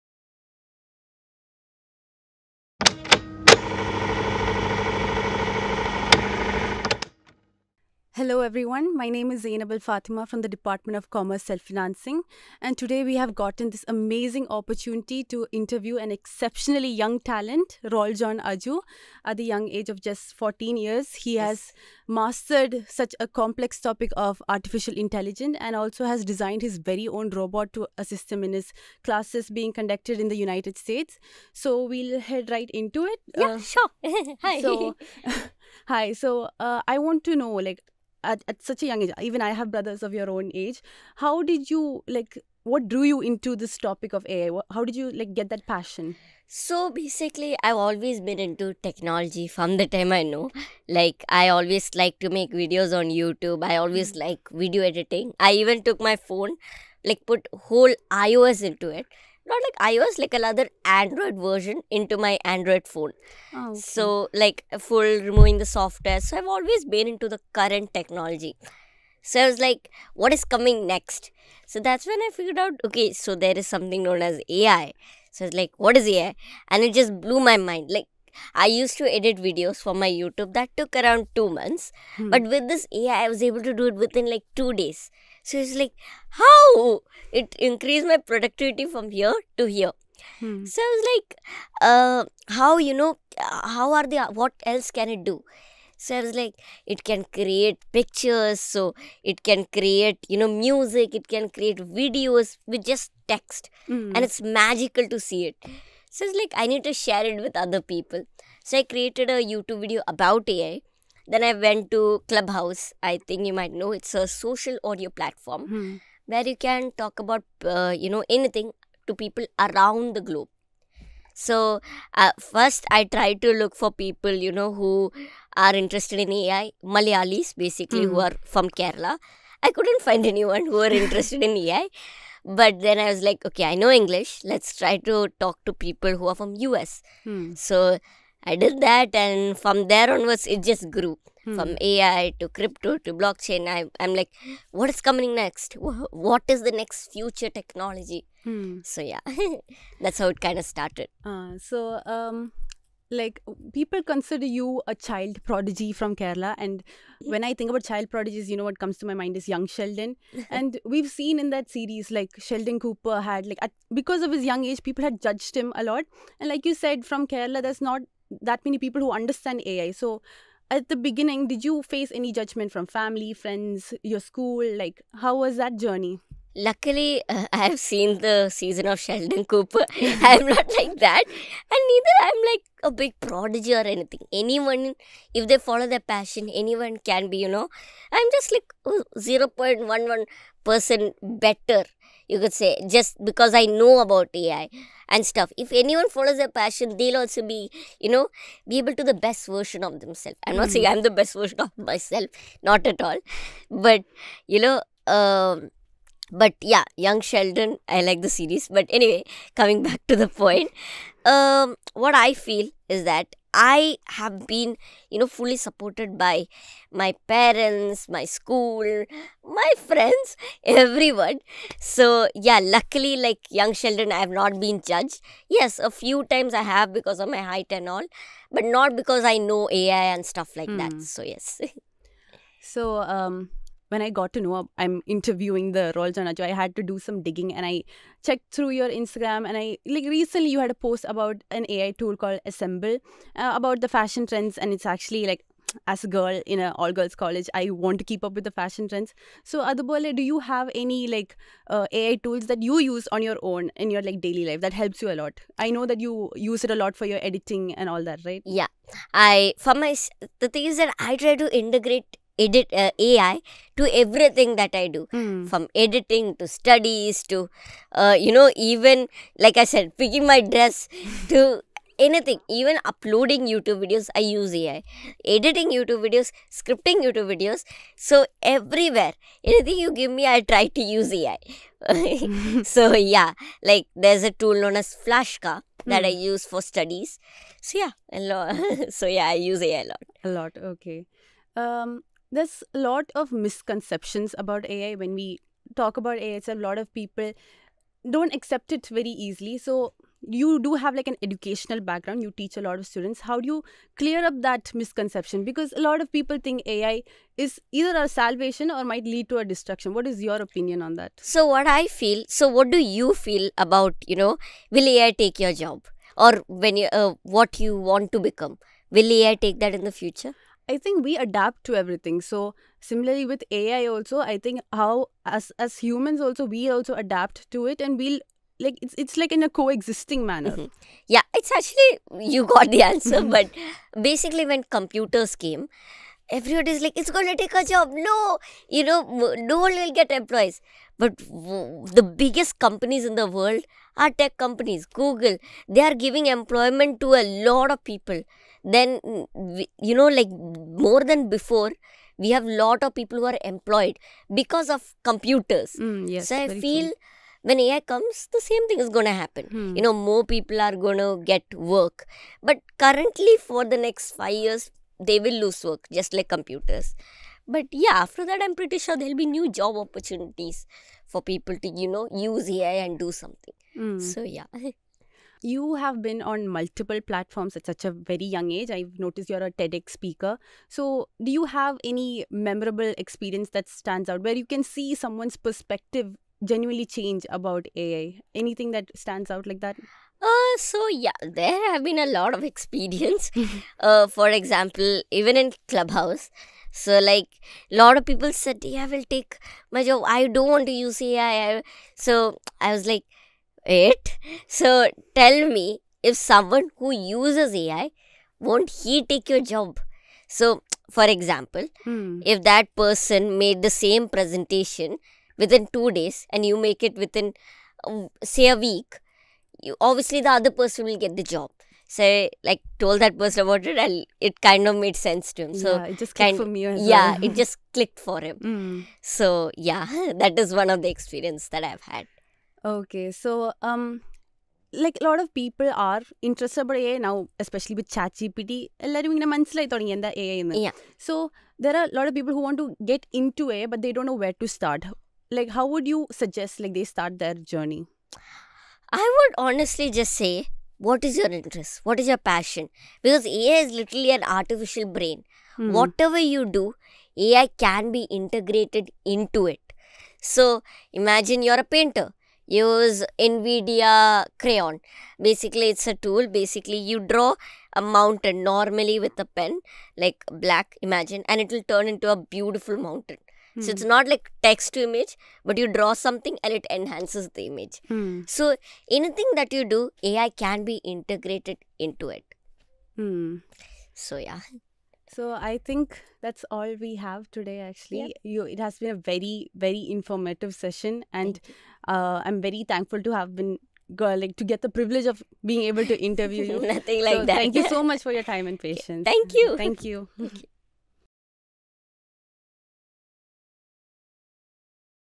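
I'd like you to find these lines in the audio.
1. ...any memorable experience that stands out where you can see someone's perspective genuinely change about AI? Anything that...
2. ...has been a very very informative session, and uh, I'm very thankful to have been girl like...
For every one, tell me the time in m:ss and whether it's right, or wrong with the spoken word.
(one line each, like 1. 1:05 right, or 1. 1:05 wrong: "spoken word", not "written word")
1. 6:21 right
2. 8:08 right.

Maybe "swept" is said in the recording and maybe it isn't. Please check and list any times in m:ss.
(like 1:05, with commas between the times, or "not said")
not said.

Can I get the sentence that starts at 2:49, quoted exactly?
So at the beginning, did you face any judgment from family, friends, your school?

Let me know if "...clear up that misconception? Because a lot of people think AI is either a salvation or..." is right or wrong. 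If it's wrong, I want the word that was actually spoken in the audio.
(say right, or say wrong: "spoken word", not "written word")
right.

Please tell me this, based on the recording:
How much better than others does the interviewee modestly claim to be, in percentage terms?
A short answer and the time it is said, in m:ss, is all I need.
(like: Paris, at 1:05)
0.11%, at 3:09.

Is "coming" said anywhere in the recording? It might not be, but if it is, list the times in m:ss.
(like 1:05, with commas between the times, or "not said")
1:10, 2:25, 3:29.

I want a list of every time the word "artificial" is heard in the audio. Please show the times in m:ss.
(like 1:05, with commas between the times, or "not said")
0:24, 7:34.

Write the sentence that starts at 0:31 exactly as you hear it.
So we'll head right into it.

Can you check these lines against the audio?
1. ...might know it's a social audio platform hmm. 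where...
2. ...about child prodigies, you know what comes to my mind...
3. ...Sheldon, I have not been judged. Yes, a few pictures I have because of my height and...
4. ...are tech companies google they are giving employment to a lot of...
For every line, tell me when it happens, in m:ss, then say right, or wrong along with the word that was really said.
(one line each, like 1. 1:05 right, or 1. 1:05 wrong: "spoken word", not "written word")
1. 1:53 right
2. 2:37 right
3. 3:43 wrong: "times", not "pictures"
4. 5:43 right.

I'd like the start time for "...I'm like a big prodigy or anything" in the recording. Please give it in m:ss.
3:02.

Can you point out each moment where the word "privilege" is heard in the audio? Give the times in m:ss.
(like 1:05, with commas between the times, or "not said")
8:14.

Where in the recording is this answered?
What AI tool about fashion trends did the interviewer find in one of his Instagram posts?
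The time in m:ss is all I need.
4:02.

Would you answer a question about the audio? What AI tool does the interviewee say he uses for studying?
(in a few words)
Flashka.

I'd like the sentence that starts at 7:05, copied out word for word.
So, yeah, it just clicked kind, for me.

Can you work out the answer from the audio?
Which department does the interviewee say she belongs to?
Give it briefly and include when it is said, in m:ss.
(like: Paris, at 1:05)
Commerce Self-Financing, at 0:11.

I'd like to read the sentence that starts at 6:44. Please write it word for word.
So tell me if someone who uses AI won't he take your job?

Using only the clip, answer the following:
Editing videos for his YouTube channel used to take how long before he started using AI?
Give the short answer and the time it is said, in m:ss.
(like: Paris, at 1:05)
2 months, at 1:21.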